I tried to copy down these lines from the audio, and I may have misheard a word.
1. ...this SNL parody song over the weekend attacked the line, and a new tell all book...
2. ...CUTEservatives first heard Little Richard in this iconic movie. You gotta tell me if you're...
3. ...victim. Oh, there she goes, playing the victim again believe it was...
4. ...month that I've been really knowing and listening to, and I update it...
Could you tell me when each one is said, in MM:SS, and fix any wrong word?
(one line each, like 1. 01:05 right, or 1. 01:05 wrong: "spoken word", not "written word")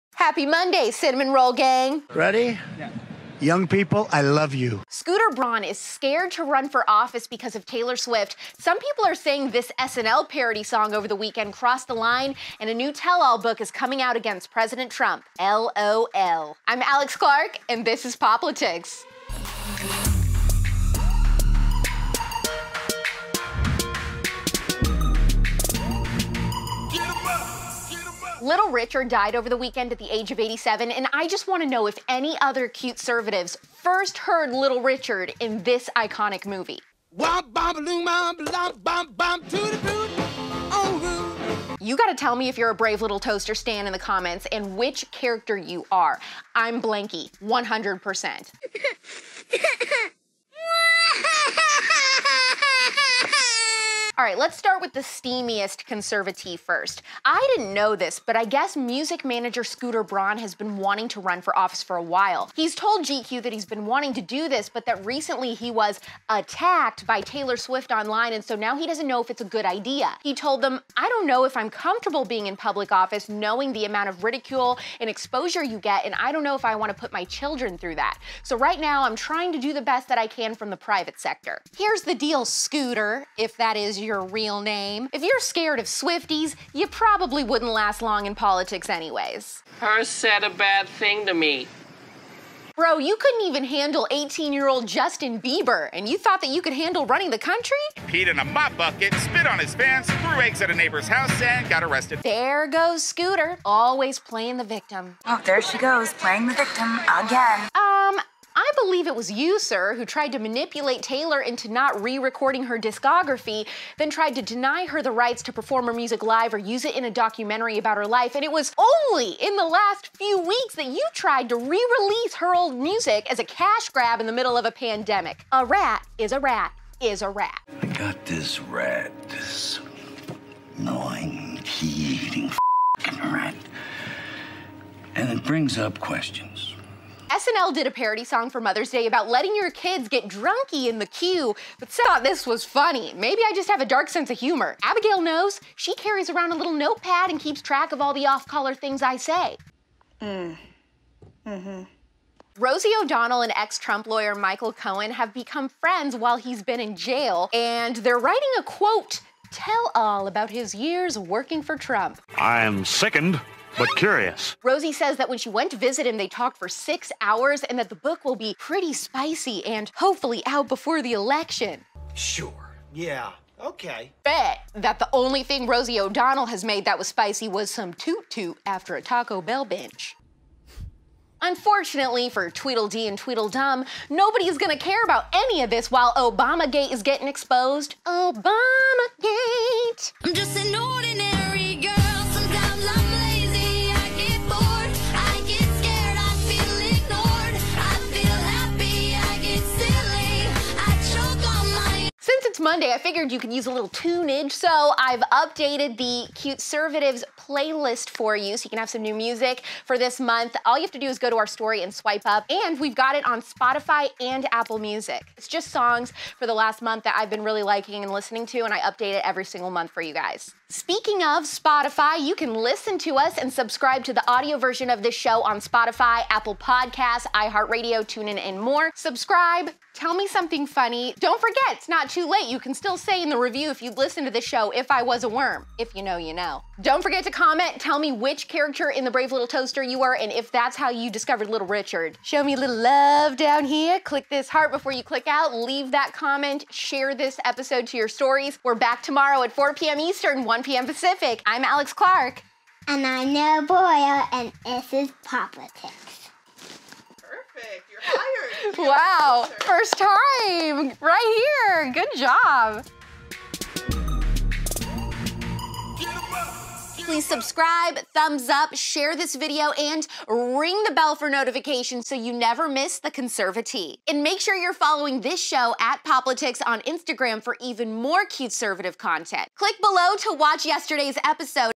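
1. 00:09 wrong: "crossed", not "attacked"
2. 00:32 right
3. 01:44 right
4. 03:36 wrong: "liking", not "knowing".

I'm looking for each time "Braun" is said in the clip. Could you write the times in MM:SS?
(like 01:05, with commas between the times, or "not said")
00:05, 01:00.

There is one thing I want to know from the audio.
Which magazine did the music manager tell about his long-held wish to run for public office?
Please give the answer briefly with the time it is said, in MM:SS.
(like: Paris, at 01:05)
GQ, at 01:03.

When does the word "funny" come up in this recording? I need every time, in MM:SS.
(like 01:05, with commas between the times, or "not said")
02:22, 03:50.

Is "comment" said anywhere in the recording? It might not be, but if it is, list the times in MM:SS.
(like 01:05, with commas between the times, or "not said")
00:43, 03:57, 04:06.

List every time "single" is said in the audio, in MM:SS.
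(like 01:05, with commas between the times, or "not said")
03:39.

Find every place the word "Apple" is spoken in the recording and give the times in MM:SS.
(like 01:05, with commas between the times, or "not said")
03:34, 03:46.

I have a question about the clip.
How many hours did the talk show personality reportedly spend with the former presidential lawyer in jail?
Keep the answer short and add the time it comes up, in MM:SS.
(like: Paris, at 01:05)
6, at 02:46.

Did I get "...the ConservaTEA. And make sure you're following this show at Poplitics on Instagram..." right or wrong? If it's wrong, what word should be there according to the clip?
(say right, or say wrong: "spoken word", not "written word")
right.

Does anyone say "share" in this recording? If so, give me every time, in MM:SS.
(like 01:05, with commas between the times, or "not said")
04:06, 04:28.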